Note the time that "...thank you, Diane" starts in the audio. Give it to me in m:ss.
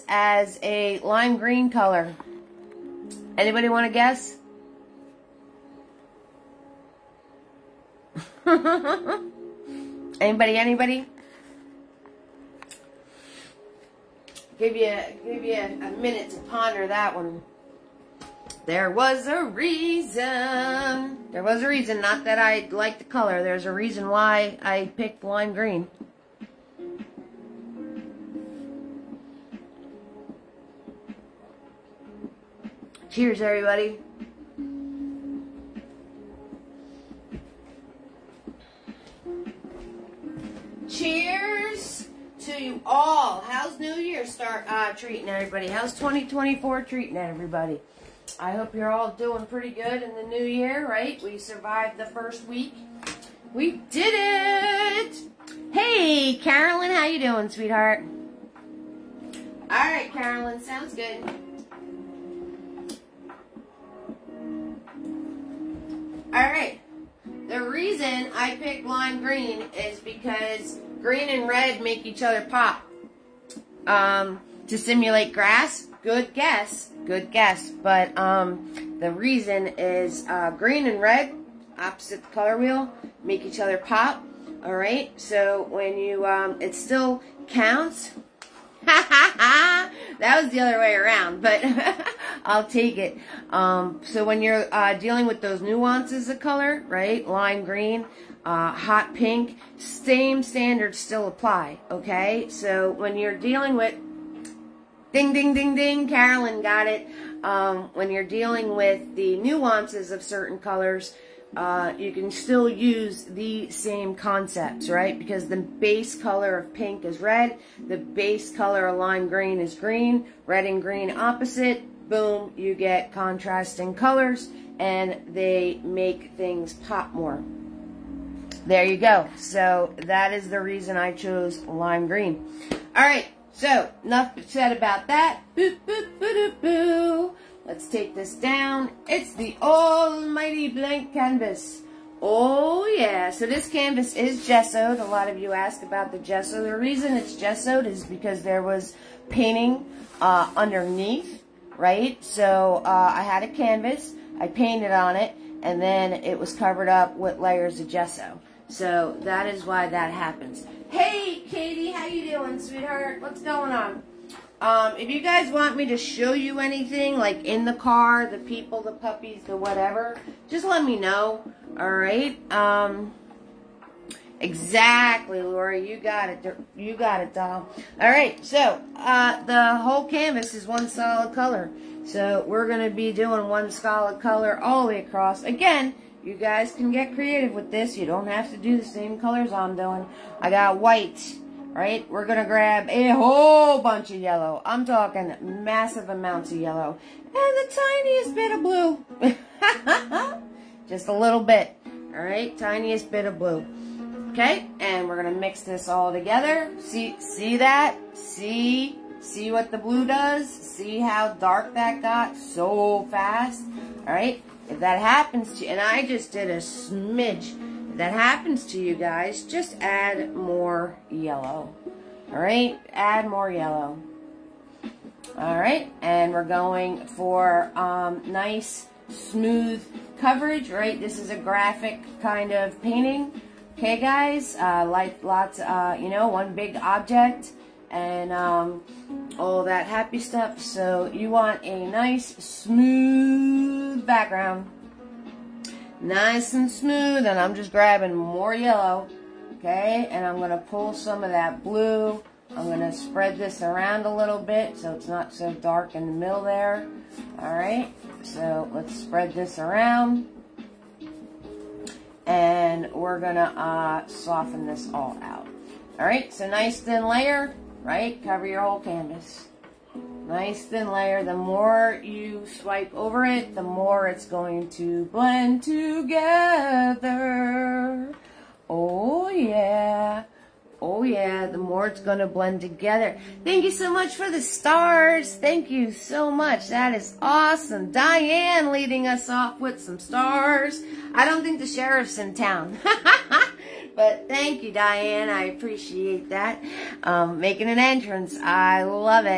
4:54.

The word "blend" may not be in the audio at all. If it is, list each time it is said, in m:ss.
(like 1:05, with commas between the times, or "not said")
4:35, 4:42.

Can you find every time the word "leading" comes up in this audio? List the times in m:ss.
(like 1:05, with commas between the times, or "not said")
4:48.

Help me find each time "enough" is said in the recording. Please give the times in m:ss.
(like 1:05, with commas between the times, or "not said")
2:14.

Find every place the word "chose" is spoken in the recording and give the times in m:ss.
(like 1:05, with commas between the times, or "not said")
2:11.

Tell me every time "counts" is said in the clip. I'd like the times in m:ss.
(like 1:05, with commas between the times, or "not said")
1:27.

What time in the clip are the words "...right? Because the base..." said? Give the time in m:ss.
1:54.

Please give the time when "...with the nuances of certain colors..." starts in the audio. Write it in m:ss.
1:48.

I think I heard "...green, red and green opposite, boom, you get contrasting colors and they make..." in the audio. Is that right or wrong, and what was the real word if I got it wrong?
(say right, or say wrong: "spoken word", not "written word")
right.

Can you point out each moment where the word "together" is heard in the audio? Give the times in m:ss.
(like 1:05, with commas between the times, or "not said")
3:26, 4:35, 4:42.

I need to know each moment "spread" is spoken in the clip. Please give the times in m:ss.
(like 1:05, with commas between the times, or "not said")
4:12, 4:18.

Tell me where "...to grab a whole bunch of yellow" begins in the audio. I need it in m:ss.
3:12.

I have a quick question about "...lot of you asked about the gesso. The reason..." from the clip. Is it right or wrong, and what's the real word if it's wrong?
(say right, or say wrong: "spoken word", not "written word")
right.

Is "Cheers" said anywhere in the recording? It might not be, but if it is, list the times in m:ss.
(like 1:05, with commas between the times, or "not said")
0:33, 0:40.